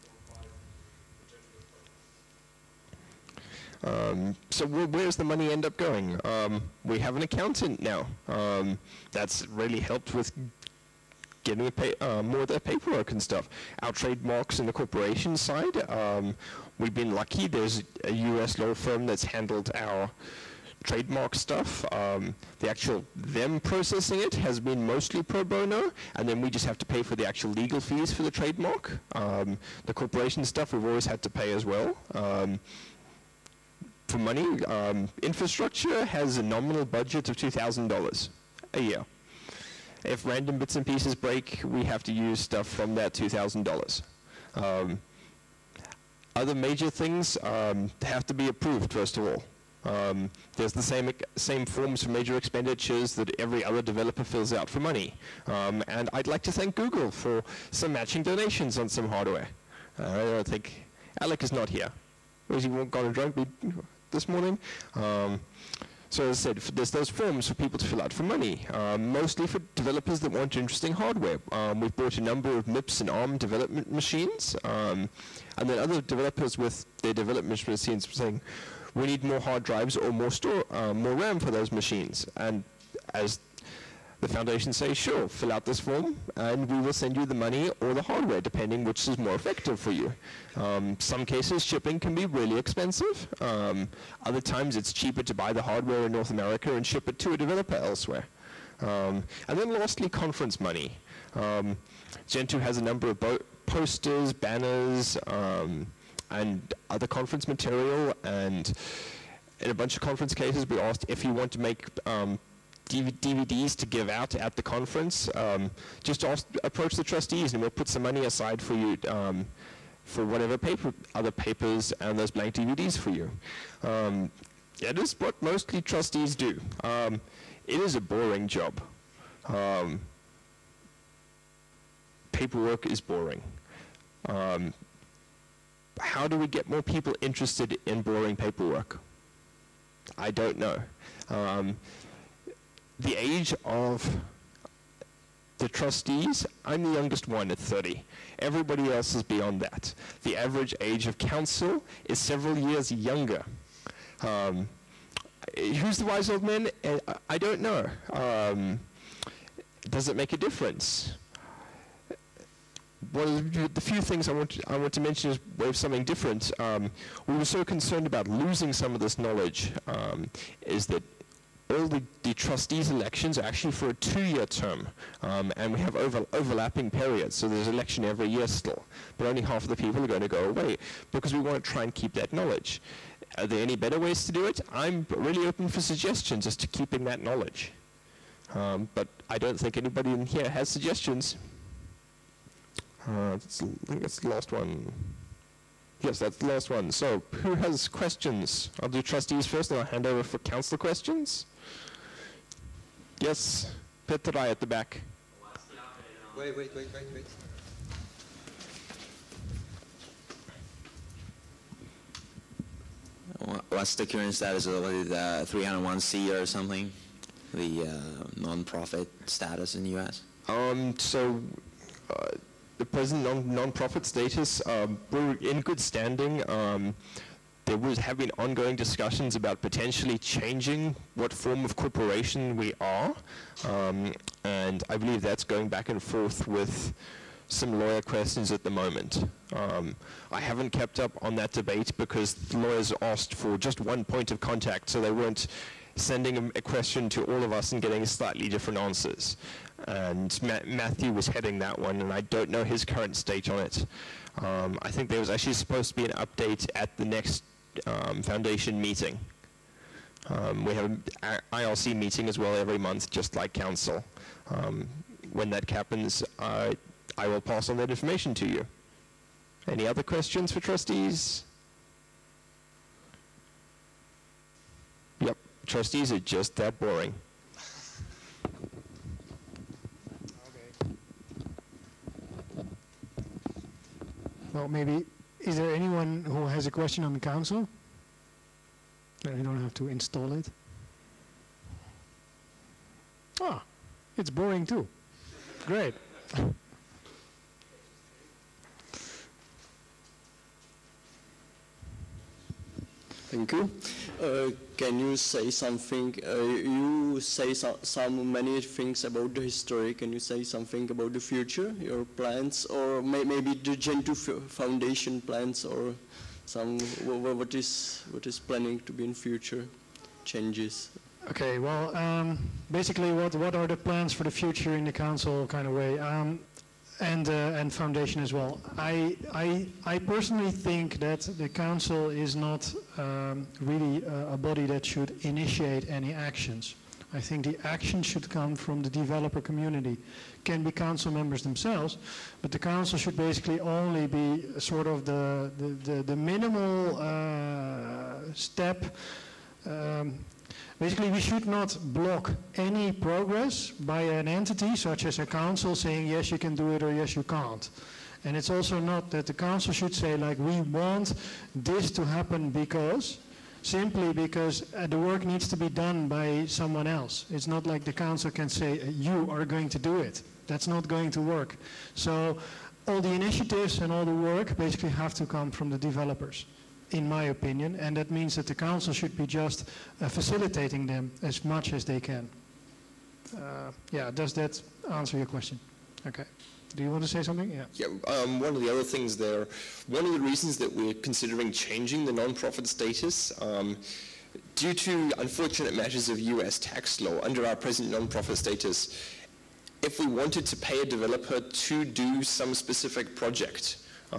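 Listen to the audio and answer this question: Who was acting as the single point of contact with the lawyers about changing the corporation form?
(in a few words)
Matthew.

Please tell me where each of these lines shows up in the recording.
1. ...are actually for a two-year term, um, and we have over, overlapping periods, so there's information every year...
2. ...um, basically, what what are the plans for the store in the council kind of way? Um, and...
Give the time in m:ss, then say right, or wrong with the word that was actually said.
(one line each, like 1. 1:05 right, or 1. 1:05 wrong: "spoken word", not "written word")
1. 2:53 wrong: "election", not "information"
2. 5:21 wrong: "future", not "store".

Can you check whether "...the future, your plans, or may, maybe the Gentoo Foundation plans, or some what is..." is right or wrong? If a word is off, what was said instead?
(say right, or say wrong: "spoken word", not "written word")
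right.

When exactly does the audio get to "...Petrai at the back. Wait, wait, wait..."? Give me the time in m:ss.
3:24.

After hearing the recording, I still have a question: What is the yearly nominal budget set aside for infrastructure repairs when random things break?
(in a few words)
$2,000.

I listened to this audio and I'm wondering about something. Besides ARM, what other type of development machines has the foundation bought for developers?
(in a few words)
MIPS.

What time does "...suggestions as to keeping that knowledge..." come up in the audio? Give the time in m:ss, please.
3:05.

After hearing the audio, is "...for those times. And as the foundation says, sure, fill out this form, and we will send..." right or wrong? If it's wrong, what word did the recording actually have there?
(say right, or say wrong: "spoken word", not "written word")
wrong: "machines", not "times".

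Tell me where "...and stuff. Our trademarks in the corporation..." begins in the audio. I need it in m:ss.
0:13.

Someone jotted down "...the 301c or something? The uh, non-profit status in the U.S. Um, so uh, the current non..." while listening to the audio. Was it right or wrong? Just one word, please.
wrong.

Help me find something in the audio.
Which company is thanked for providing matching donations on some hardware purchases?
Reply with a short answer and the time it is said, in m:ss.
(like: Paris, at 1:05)
Google, at 0:56.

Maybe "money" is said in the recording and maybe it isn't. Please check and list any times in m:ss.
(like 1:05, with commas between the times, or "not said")
0:05, 0:34, 0:54, 1:08, 1:27, 1:40, 1:58.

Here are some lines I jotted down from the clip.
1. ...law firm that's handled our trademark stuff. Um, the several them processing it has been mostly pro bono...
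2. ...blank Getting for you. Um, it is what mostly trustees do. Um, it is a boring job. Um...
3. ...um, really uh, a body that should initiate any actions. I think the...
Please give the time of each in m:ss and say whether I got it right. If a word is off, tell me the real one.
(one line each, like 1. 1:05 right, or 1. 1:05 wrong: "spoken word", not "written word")
1. 0:18 wrong: "actual", not "several"
2. 2:02 wrong: "DVDs", not "Getting"
3. 5:32 right.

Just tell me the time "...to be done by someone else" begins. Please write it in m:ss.
6:05.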